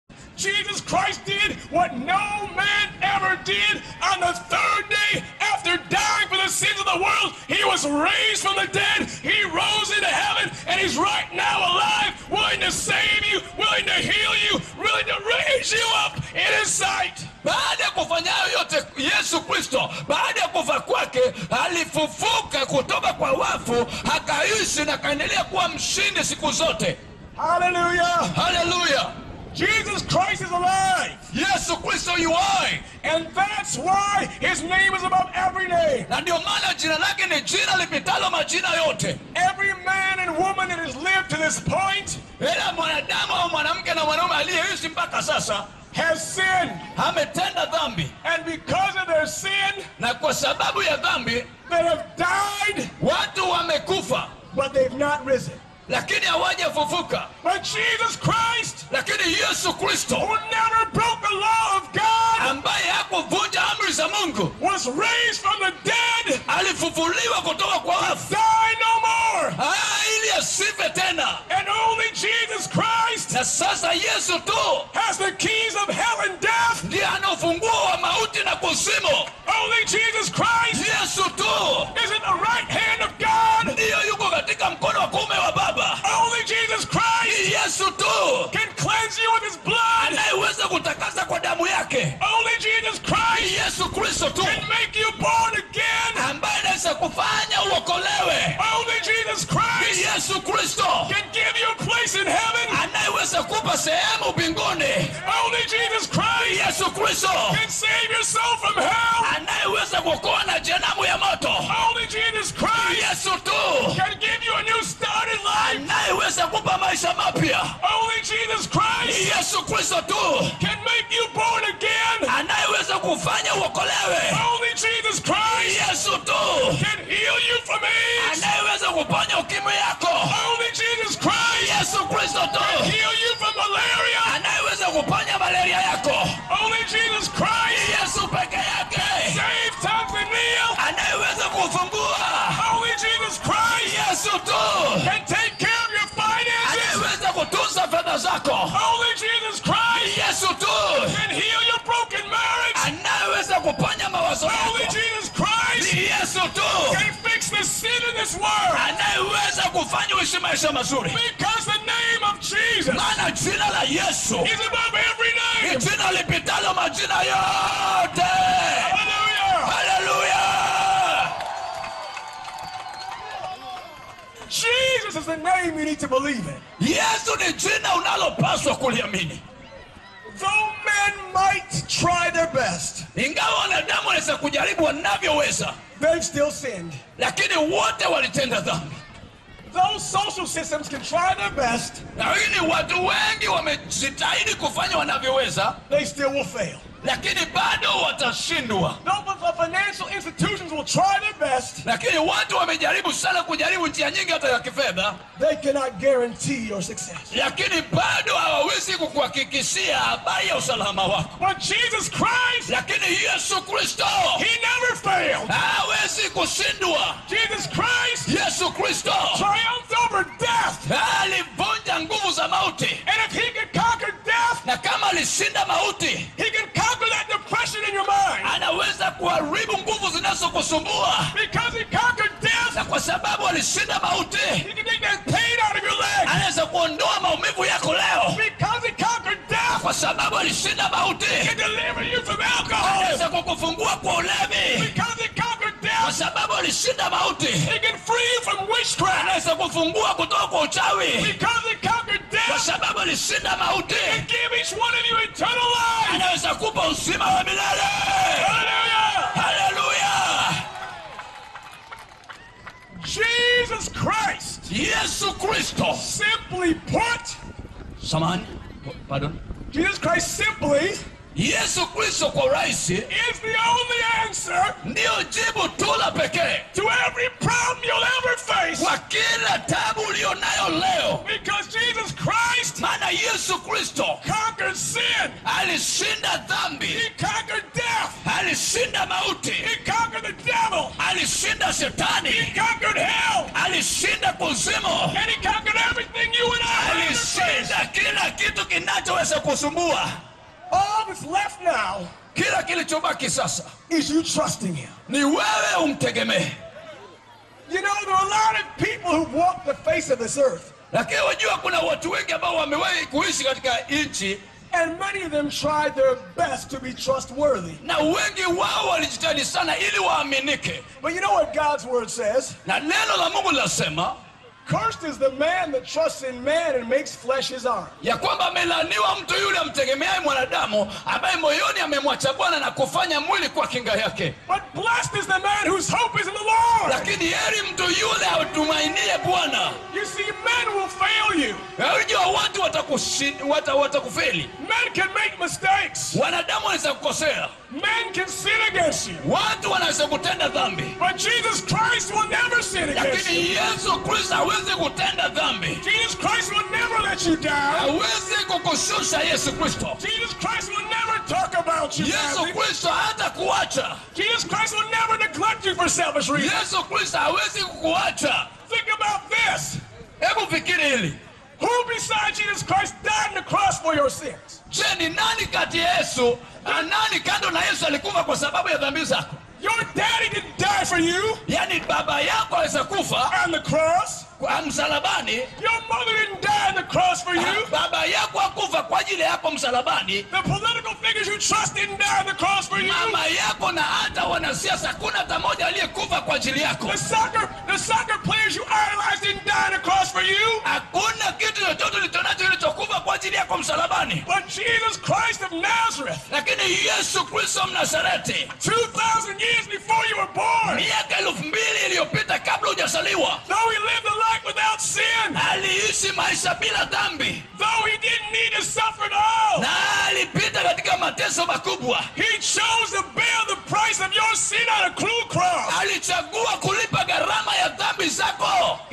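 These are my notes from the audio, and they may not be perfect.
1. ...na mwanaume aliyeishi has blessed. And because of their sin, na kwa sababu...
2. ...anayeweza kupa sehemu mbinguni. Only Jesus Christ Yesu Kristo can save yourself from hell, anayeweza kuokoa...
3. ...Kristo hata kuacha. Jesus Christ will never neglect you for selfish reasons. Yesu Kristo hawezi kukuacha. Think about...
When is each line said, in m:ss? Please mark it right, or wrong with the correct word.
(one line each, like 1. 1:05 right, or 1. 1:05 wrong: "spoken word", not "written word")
1. 0:43 wrong: "sinned", not "blessed"
2. 1:42 right
3. 6:02 right.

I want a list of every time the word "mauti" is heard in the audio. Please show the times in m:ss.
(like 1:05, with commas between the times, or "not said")
1:18, 3:53, 4:00, 4:07, 4:13, 4:49.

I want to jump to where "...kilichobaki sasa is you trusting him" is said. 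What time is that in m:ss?
5:02.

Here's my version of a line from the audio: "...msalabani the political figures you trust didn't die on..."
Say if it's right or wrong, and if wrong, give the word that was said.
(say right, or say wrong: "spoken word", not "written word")
right.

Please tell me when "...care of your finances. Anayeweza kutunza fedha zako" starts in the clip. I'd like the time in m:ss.
2:25.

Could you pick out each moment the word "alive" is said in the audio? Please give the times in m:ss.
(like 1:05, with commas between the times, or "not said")
0:11, 0:30.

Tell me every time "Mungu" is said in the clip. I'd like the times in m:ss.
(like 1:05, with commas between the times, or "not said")
1:04, 5:23.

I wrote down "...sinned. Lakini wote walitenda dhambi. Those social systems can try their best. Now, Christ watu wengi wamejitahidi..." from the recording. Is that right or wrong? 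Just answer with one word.
wrong.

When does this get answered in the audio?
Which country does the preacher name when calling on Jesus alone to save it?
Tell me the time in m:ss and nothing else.
2:19.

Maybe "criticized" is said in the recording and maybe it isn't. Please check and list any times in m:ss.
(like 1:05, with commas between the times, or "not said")
not said.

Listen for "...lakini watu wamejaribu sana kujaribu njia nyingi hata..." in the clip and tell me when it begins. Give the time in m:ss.
3:21.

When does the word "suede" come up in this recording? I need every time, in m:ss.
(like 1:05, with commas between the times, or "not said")
not said.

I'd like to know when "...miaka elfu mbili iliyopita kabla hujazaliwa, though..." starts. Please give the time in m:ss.
6:50.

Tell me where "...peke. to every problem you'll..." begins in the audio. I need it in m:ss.
4:36.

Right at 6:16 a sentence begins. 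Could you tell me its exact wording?
Nani kando na Yesu alikufa kwa sababu ya dhambi zako?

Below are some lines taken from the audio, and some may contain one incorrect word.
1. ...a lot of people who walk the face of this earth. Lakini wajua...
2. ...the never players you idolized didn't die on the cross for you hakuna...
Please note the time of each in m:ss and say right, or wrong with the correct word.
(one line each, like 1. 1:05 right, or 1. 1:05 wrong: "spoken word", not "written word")
1. 5:08 right
2. 6:37 wrong: "soccer", not "never".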